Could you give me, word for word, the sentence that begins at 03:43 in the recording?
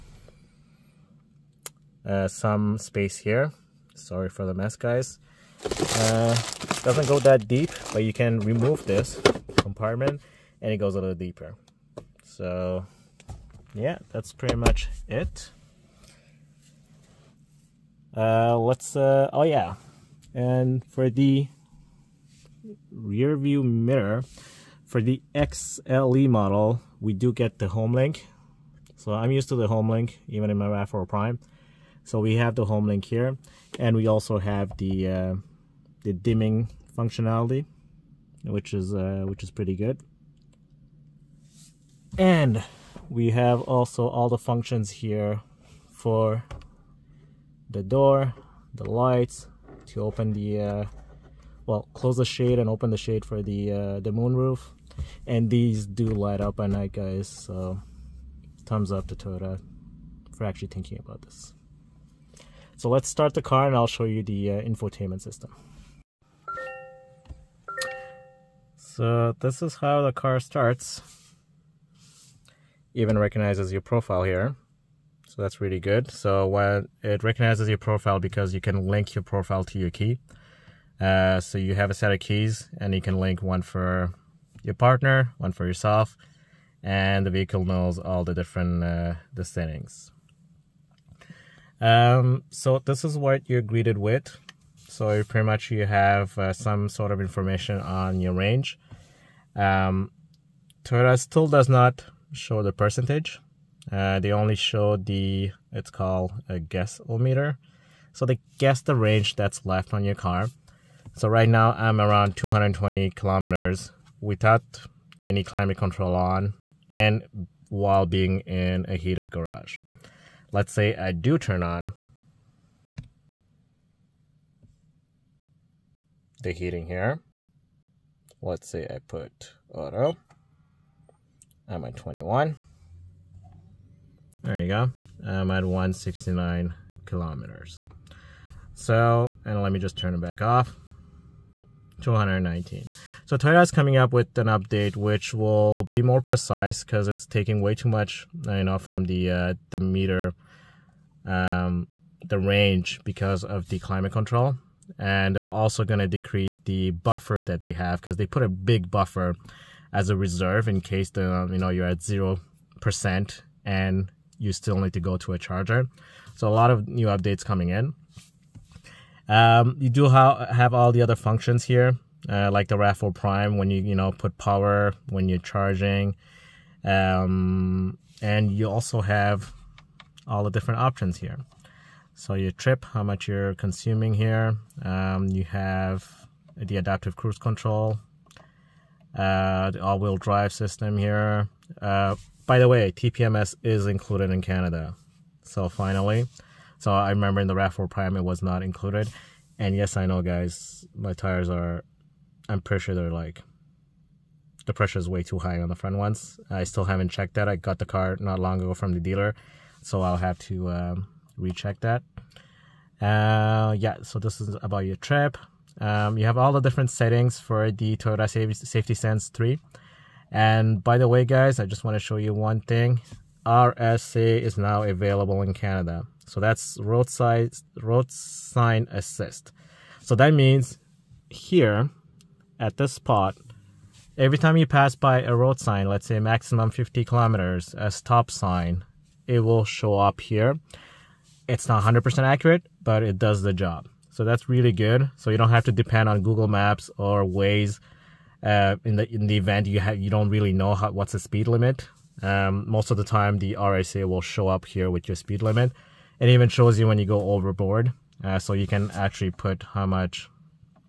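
RSA is now available in Canada.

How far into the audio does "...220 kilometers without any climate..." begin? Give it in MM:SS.
01:52.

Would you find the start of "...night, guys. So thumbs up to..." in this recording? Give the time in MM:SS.
00:56.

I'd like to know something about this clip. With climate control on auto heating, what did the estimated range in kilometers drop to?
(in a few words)
169 kilometers.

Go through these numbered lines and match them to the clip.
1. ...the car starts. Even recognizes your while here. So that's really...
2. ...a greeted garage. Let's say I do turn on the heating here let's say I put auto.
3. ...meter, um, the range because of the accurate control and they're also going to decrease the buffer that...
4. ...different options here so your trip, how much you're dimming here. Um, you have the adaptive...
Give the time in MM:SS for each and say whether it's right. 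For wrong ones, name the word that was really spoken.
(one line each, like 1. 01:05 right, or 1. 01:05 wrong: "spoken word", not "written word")
1. 01:10 wrong: "profile", not "while"
2. 01:58 wrong: "heated", not "greeted"
3. 02:29 wrong: "climate", not "accurate"
4. 03:00 wrong: "consuming", not "dimming".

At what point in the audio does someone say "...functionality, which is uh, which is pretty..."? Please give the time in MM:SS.
00:36.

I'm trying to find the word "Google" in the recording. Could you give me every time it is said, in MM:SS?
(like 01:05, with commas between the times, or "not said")
04:06.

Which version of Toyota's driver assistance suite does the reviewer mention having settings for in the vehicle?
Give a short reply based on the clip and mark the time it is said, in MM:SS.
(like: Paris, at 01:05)
Toyota Safety Sense 3, at 03:37.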